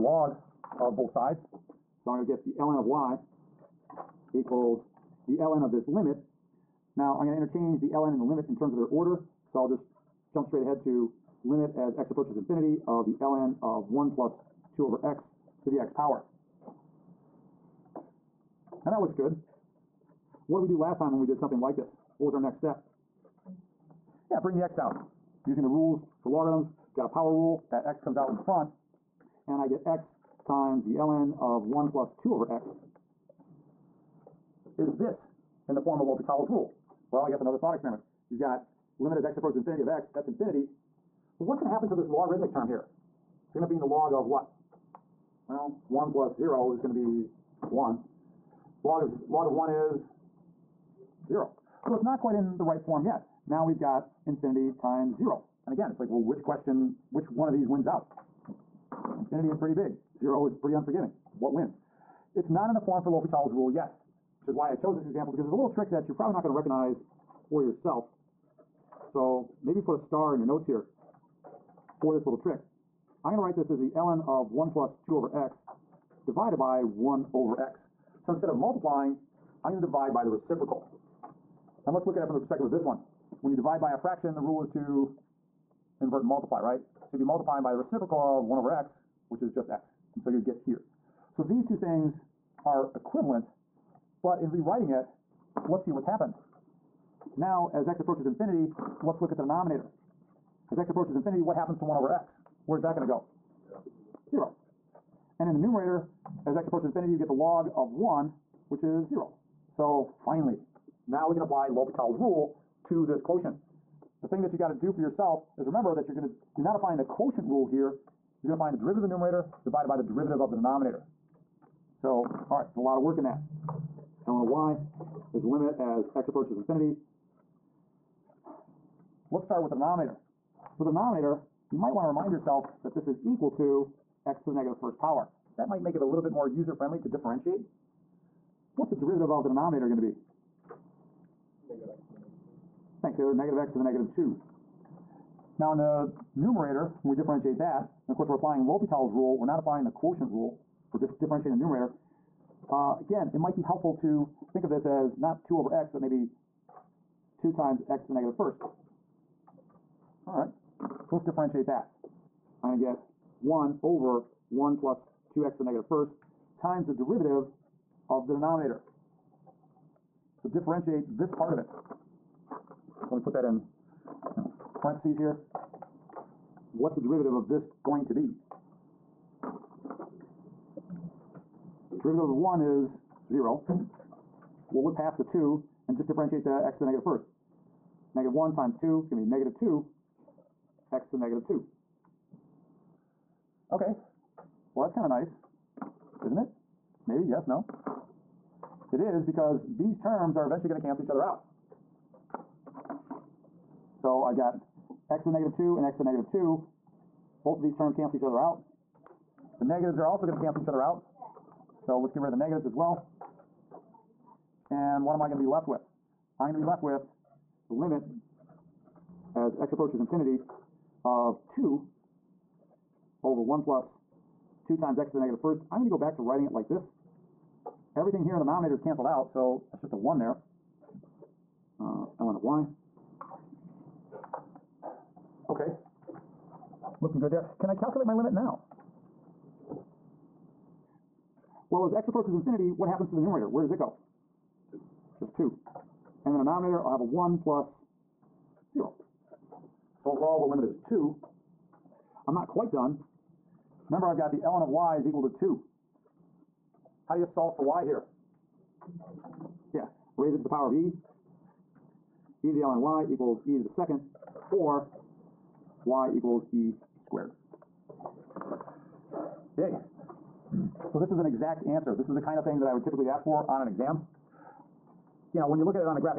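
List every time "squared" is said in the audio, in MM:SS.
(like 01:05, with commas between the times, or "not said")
04:26.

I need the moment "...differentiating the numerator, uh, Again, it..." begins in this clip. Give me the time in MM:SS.
02:31.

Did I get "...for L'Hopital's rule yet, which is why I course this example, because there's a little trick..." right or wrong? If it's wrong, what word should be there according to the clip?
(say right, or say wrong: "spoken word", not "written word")
wrong: "chose", not "course".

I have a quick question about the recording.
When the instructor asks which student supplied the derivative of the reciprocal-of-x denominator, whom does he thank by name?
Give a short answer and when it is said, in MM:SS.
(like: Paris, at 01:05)
Taylor, at 02:23.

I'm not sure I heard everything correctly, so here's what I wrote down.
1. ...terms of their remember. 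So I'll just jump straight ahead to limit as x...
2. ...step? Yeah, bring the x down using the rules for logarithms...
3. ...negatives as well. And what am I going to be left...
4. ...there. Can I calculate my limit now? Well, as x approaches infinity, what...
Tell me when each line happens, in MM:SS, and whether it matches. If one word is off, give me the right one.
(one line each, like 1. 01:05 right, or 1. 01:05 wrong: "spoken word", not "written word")
1. 00:08 wrong: "order", not "remember"
2. 00:22 right
3. 03:32 right
4. 03:57 right.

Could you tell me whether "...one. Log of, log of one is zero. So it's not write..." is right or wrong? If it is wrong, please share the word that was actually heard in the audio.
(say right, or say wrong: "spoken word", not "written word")
wrong: "quite", not "write".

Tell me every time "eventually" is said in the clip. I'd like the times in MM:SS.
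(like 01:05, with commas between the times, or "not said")
03:20.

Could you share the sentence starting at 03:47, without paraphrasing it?
Everything here in the denominator is canceled out, so it's just a 1 there.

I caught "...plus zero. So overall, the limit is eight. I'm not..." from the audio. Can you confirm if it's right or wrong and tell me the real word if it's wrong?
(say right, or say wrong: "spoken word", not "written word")
wrong: "two", not "eight".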